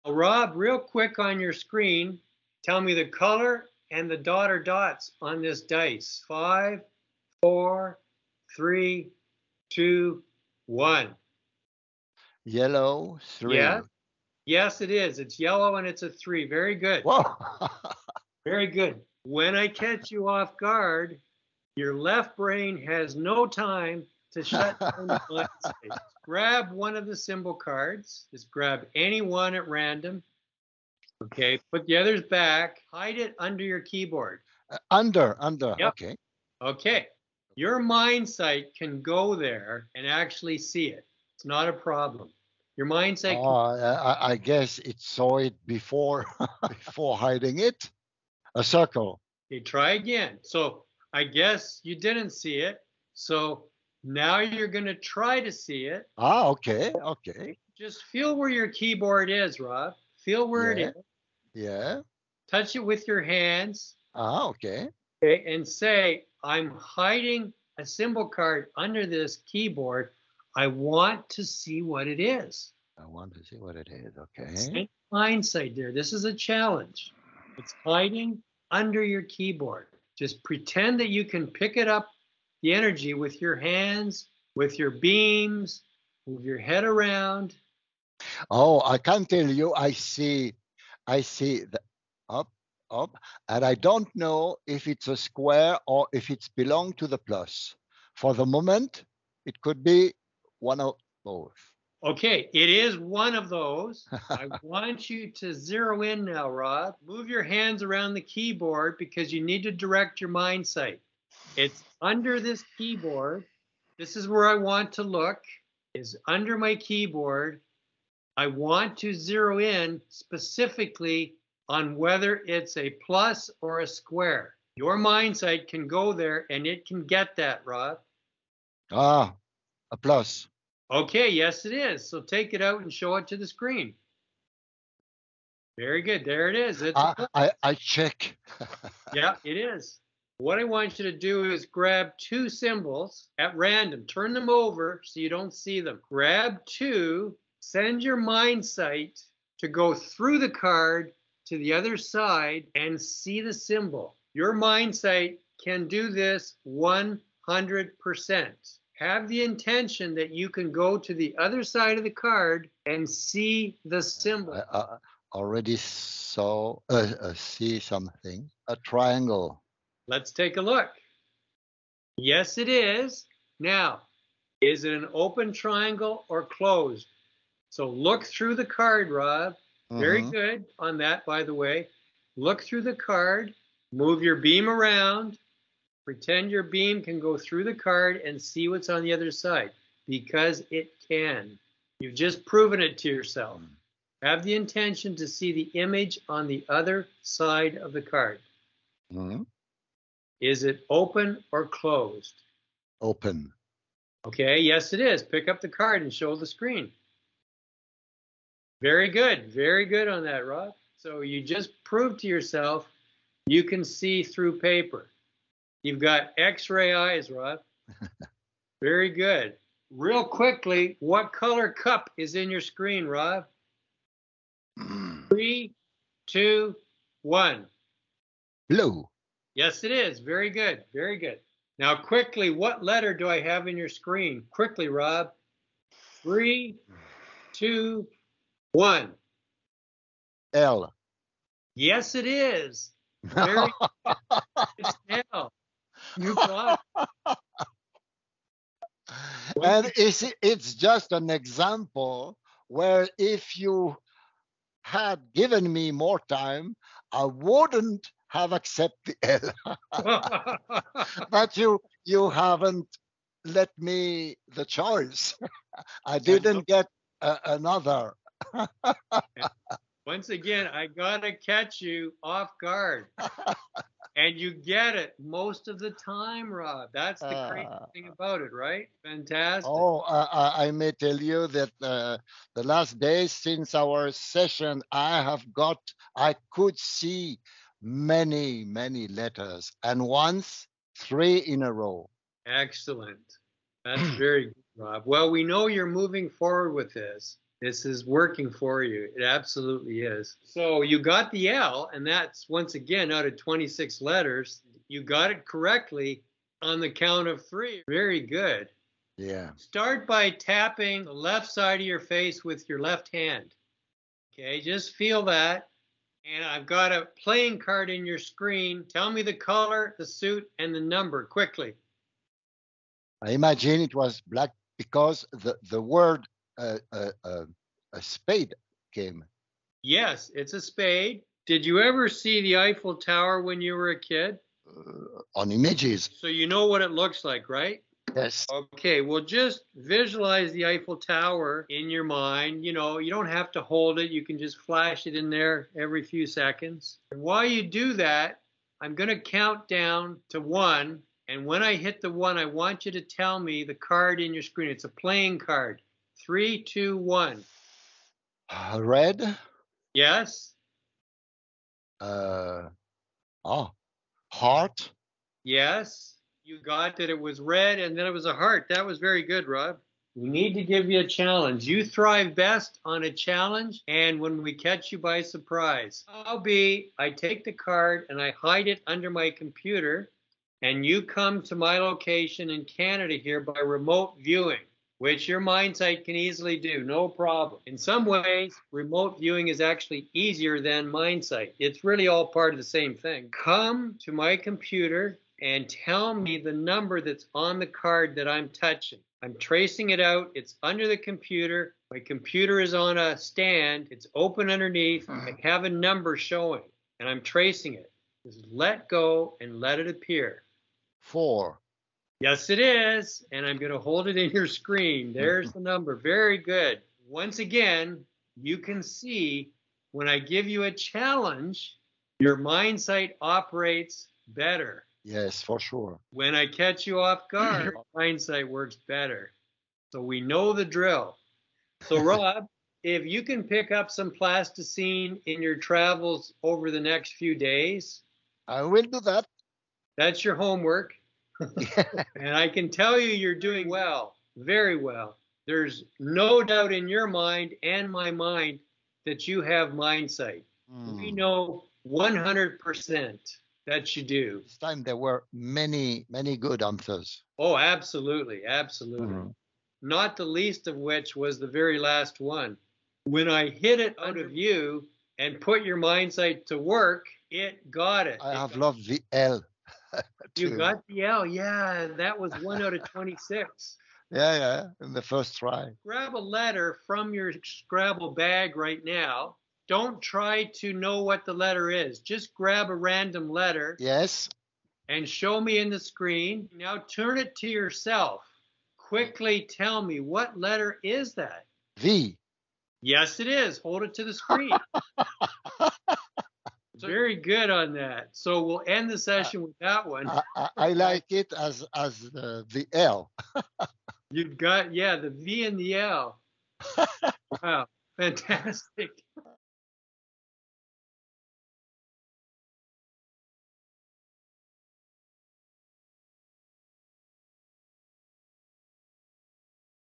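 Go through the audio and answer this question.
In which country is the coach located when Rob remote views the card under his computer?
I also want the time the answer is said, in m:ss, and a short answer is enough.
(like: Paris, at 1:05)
Canada, at 6:22.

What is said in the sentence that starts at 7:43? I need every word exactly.
When I hid it out of view and put your mind sight to work, it got it.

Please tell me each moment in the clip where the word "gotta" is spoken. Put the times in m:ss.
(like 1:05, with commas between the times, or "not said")
4:30.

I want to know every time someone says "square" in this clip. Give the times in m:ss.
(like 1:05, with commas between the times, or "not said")
1:35, 2:03.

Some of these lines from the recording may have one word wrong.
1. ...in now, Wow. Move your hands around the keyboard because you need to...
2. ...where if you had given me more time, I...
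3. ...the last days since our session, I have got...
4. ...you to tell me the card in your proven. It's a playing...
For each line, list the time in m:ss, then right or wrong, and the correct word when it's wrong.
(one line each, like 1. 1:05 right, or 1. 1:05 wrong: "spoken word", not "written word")
1. 1:46 wrong: "Rob", not "Wow"
2. 4:12 right
3. 4:42 right
4. 5:52 wrong: "screen", not "proven".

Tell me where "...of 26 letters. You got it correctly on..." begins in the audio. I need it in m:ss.
5:03.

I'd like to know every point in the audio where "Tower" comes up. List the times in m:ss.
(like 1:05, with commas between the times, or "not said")
5:32, 5:40.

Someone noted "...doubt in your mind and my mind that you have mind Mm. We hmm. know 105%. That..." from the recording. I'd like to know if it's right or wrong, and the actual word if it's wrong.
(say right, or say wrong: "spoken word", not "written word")
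wrong: "100", not "105".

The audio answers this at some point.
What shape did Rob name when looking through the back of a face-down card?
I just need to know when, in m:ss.
2:48.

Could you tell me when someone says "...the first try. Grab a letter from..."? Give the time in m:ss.
7:54.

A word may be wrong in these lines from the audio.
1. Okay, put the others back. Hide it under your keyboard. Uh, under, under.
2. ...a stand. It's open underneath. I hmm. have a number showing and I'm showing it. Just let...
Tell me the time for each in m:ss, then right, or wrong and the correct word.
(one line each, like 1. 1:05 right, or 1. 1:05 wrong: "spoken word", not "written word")
1. 0:31 right
2. 6:42 wrong: "tracing", not "showing".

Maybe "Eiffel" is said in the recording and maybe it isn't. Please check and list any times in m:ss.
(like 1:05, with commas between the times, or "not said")
5:32, 5:40.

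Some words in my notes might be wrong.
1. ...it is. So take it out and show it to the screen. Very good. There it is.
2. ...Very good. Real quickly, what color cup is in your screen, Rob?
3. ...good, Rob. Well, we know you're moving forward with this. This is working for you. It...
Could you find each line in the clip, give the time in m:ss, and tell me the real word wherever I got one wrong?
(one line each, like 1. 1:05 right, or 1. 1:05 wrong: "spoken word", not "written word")
1. 2:11 right
2. 3:38 right
3. 4:54 right.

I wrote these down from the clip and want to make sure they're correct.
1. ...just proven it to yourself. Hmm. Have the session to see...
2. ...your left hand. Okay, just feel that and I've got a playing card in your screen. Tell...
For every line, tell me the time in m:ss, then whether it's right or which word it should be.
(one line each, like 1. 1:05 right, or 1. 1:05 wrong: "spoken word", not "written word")
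1. 3:12 wrong: "intention", not "session"
2. 5:12 right.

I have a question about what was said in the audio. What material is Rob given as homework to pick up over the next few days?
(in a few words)
Plasticine.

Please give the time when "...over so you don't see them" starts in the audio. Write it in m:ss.
2:24.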